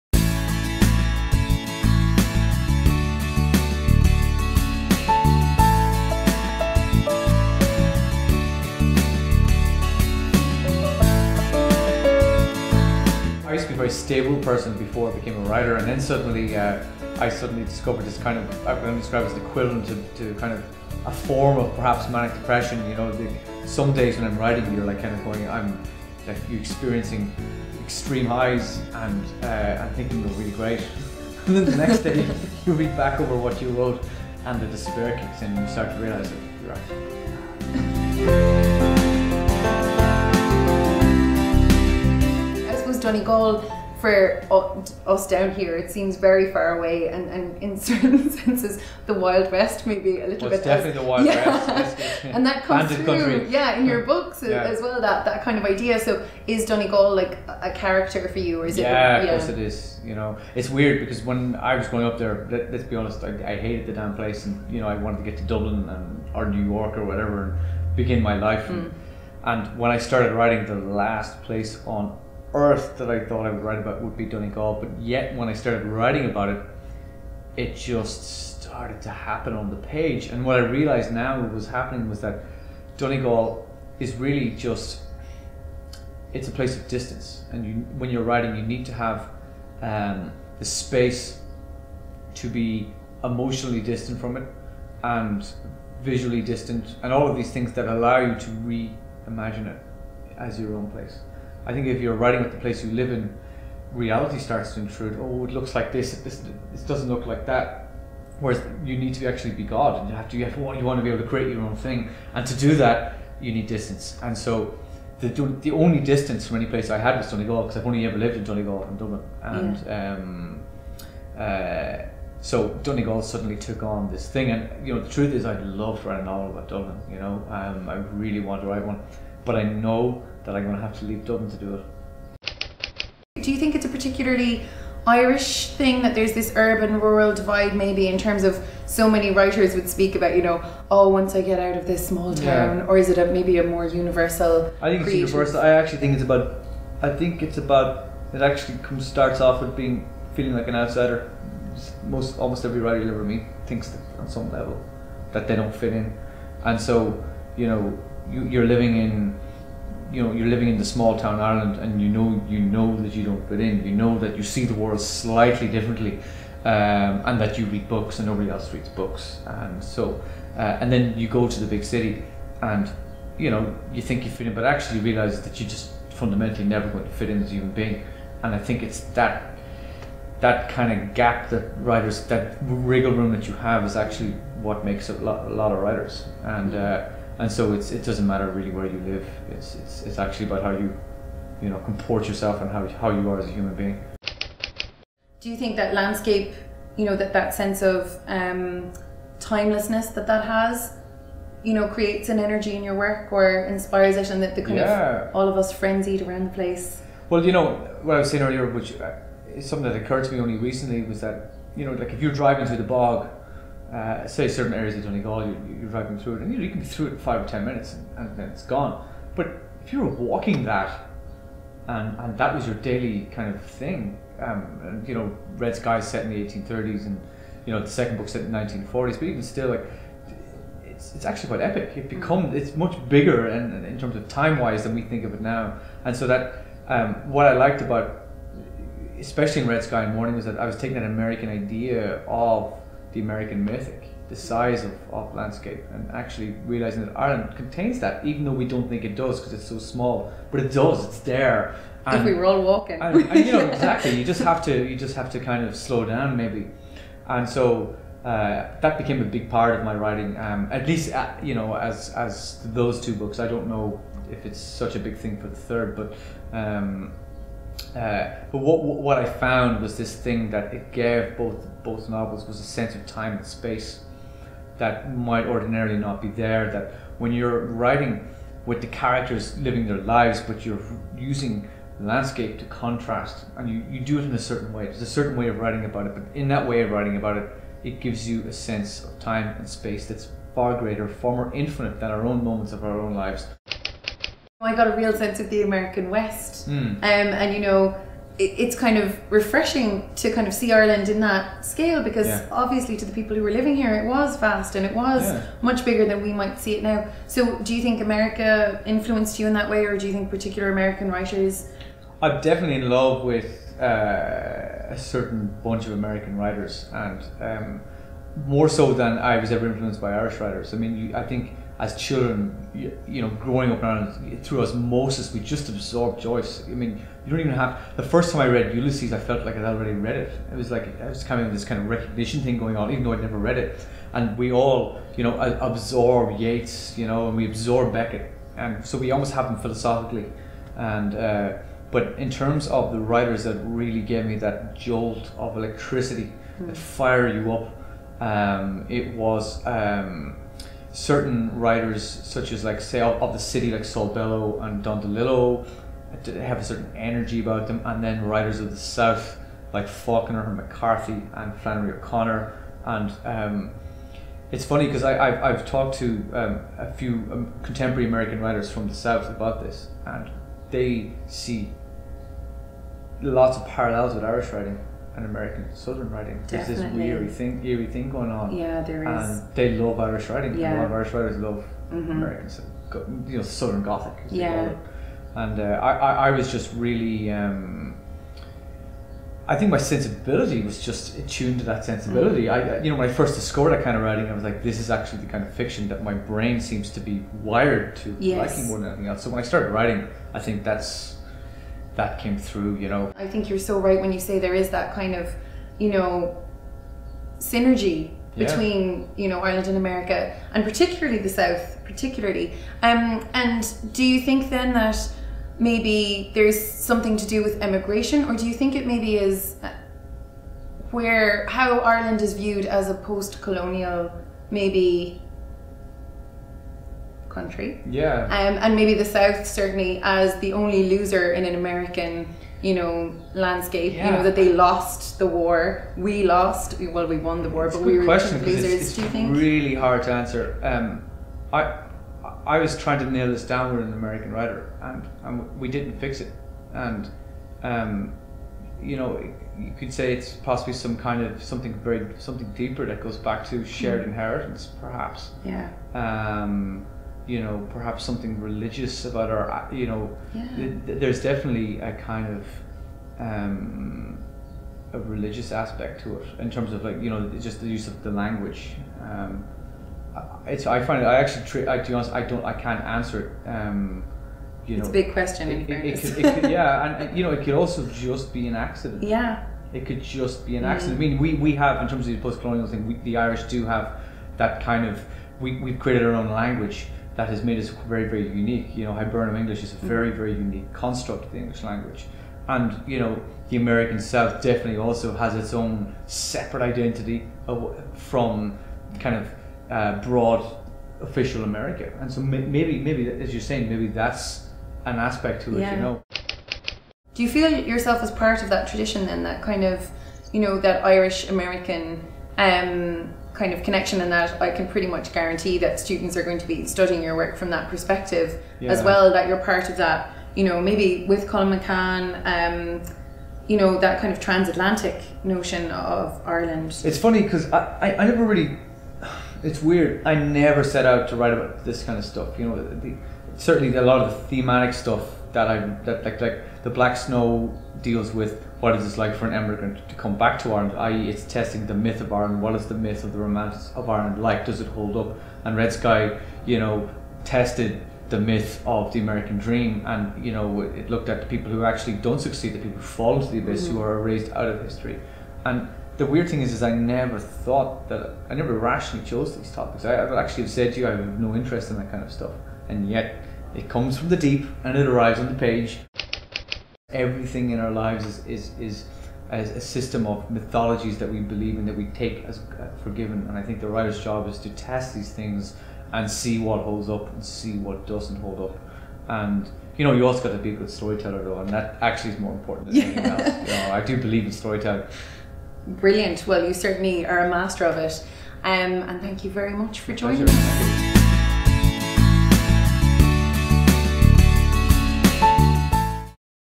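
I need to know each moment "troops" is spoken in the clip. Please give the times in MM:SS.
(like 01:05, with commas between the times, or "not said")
not said.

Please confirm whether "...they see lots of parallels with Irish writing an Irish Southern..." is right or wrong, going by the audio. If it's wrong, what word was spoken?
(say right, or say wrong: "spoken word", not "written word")
wrong: "American", not "Irish".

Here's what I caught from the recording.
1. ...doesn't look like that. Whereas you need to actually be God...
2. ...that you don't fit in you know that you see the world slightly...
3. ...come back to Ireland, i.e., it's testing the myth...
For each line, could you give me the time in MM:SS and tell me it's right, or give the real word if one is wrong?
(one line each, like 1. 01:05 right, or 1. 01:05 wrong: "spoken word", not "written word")
1. 01:46 right
2. 02:43 right
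3. 08:59 right.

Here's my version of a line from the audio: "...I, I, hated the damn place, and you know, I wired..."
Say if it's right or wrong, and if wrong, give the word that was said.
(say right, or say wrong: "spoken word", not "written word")
wrong: "wanted", not "wired".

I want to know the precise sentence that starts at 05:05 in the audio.
much bigger than we might see it now.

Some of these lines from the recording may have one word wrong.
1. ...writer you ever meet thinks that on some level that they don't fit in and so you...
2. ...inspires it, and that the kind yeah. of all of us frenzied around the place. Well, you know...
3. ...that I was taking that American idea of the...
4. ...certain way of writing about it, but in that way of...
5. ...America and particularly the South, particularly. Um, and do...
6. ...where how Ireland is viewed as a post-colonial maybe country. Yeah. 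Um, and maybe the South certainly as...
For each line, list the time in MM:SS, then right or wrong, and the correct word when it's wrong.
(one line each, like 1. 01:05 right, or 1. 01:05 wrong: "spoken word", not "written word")
1. 02:32 right
2. 03:23 right
3. 04:00 right
4. 04:45 right
5. 06:49 right
6. 07:00 right.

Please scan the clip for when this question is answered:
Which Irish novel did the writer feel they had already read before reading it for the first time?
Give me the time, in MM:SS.
05:28.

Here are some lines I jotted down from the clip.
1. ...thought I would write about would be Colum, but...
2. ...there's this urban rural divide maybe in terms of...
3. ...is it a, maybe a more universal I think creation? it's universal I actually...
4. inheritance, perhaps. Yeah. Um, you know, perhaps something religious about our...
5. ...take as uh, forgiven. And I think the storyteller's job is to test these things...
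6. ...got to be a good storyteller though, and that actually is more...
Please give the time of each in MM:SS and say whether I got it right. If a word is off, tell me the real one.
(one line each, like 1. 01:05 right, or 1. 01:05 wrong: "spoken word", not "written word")
1. 01:13 wrong: "Donegal", not "Colum"
2. 02:16 right
3. 02:22 right
4. 07:34 right
5. 09:31 wrong: "writer", not "storyteller"
6. 09:40 right.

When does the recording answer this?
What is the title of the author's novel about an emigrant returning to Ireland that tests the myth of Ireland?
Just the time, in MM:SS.
08:56.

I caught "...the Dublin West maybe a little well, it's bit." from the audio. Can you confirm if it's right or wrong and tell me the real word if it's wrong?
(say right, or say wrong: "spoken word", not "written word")
wrong: "Wild", not "Dublin".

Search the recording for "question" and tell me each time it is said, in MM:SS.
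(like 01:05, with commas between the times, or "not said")
07:18, 07:55.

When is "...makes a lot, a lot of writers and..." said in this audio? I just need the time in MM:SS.
03:04.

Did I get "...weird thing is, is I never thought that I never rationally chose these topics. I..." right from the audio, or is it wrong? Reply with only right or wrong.
right.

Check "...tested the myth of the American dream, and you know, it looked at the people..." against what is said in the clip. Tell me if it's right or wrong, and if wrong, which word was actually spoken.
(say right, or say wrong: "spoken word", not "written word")
right.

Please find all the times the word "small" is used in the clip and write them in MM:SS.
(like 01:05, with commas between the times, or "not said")
02:22, 02:40, 04:09.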